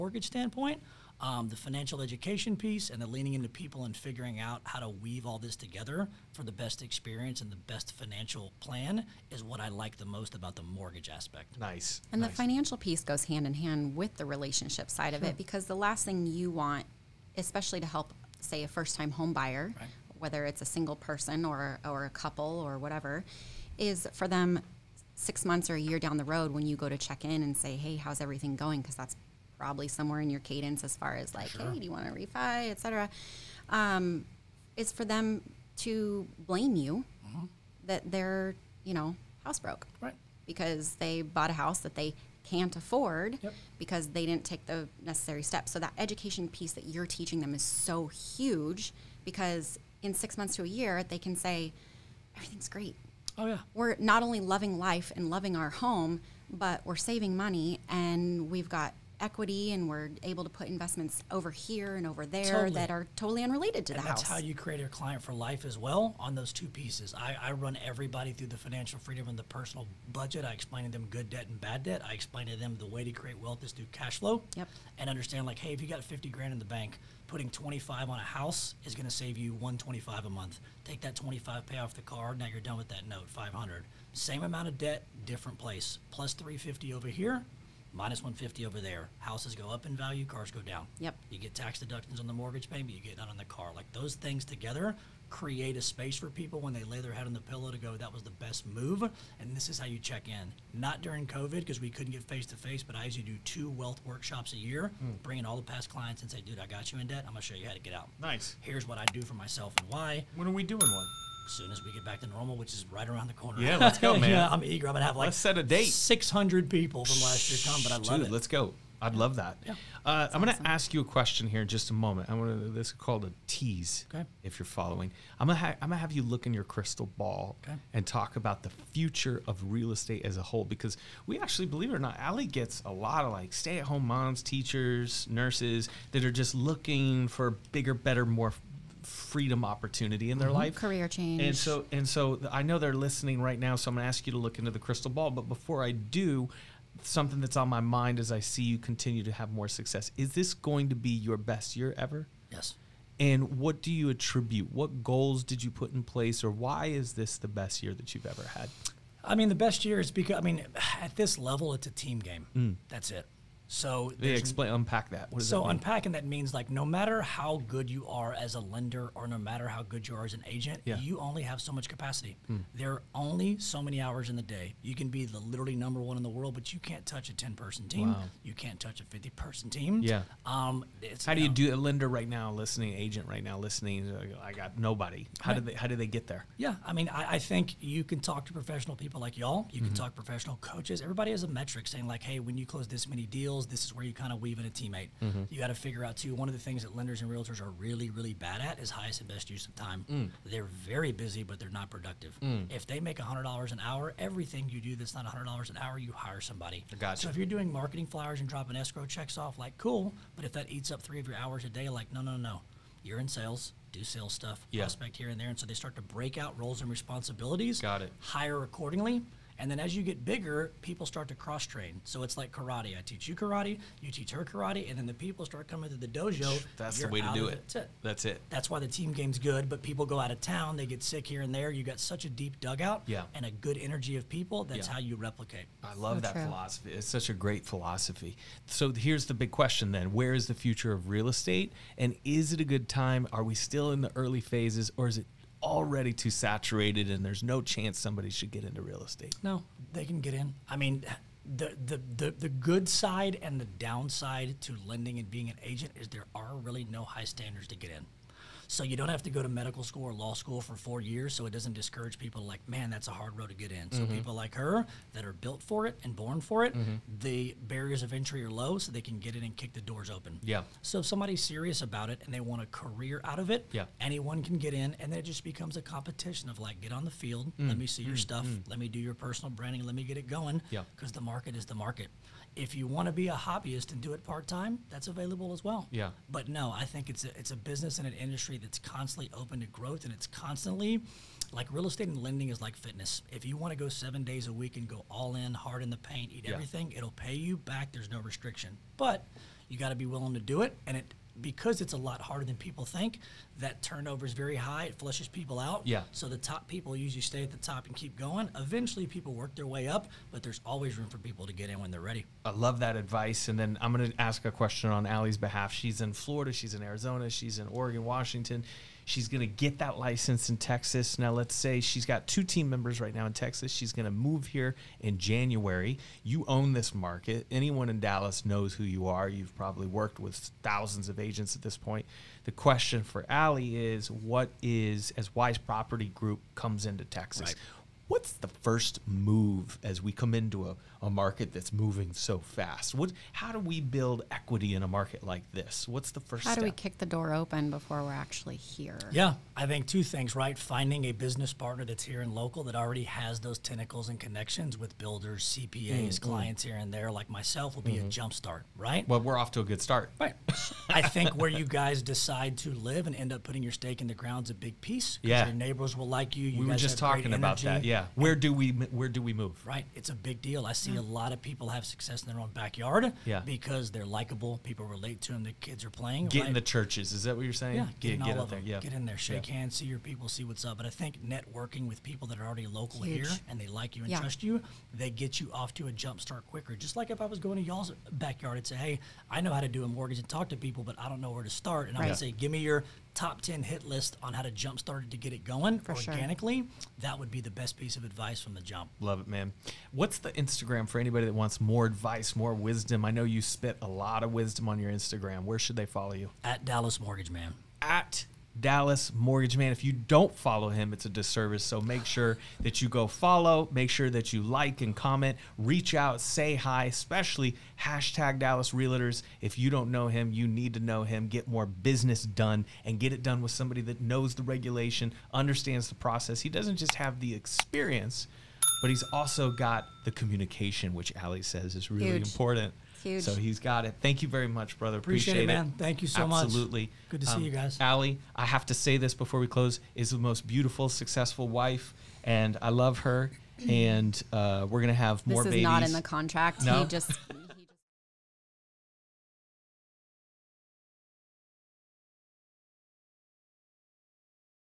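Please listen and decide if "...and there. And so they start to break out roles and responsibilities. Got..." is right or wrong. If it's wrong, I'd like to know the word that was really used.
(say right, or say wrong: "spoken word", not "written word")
right.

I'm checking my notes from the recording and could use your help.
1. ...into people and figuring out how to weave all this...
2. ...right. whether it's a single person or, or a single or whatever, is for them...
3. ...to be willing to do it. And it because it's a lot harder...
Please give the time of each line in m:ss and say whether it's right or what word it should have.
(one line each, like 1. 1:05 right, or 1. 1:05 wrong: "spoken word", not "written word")
1. 0:03 right
2. 0:19 wrong: "couple", not "single"
3. 4:59 right.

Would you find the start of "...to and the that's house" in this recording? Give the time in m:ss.
1:03.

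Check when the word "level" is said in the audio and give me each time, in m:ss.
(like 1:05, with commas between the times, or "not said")
2:41.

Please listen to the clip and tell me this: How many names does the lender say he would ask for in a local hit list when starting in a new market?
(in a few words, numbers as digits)
10.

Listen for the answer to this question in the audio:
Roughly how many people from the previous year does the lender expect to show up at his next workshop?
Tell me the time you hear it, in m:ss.
1:55.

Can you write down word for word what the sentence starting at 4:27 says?
the barriers of entry are low so they can get in and kick the doors open.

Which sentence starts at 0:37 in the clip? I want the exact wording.
that they're you know house broke, right?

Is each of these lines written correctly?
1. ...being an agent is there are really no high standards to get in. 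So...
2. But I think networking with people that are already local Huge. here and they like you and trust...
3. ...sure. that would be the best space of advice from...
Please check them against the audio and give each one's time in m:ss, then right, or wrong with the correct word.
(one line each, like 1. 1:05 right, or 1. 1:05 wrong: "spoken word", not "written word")
1. 4:15 right
2. 6:20 right
3. 6:36 wrong: "piece", not "space".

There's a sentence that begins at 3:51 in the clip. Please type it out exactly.
You got such a deep dugout yeah.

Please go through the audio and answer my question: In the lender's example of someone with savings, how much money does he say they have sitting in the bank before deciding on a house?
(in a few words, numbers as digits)
$50,000.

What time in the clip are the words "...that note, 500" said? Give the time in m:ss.
1:22.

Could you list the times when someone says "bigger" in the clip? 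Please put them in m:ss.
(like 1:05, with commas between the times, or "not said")
2:17, 3:40.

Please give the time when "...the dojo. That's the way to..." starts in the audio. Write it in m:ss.
3:45.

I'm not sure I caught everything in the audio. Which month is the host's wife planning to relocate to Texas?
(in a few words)
January.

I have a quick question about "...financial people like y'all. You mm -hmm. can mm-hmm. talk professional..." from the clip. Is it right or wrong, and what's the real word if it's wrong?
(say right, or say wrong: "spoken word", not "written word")
wrong: "professional", not "financial".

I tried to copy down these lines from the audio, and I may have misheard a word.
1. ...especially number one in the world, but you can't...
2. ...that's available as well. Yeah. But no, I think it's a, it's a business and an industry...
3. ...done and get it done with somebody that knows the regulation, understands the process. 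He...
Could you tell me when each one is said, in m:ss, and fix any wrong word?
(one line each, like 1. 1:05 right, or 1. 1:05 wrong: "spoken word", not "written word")
1. 2:55 wrong: "literally", not "especially"
2. 4:44 right
3. 7:02 right.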